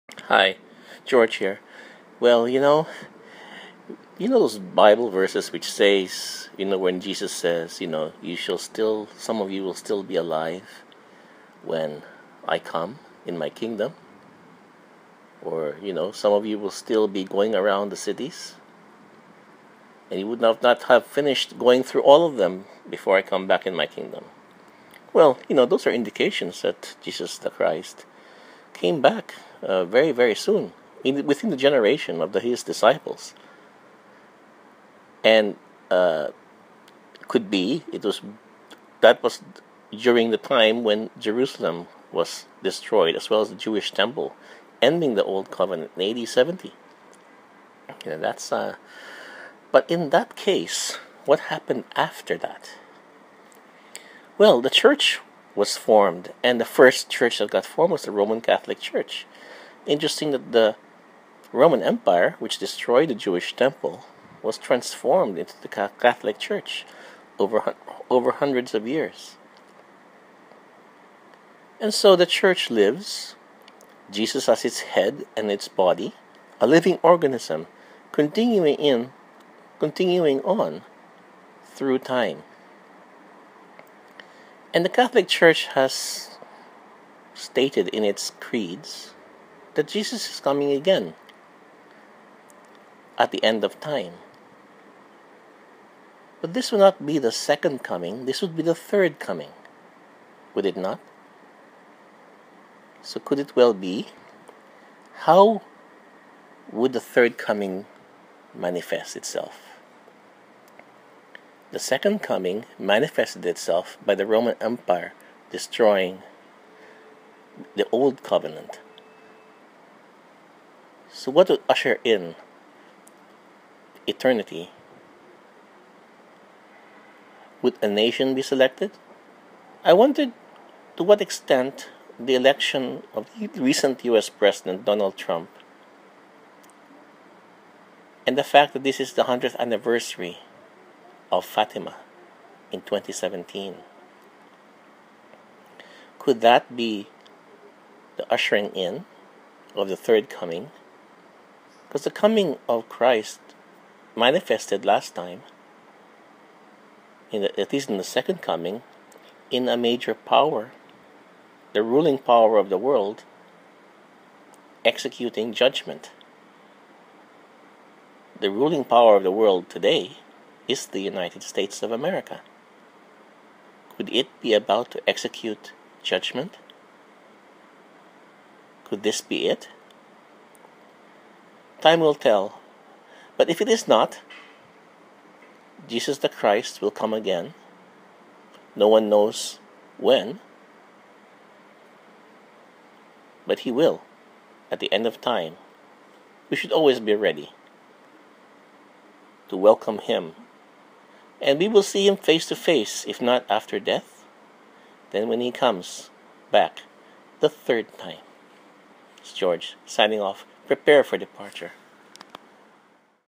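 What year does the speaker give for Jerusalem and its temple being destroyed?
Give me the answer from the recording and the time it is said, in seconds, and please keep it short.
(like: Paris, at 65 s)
AD 70, at 46 s.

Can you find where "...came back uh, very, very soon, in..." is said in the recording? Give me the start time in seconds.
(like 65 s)
28 s.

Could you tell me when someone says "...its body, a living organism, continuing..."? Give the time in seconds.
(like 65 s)
75 s.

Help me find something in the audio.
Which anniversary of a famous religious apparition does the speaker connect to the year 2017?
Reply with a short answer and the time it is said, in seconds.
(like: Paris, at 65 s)
100th anniversary of Fatima, at 139 s.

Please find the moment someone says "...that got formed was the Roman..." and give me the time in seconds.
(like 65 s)
57 s.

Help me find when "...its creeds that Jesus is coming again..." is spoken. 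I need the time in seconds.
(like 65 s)
88 s.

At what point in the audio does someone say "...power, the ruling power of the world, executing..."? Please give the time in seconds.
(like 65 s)
160 s.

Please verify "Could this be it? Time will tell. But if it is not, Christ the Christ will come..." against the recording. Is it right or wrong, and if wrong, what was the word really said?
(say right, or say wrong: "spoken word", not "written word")
wrong: "Jesus", not "Christ".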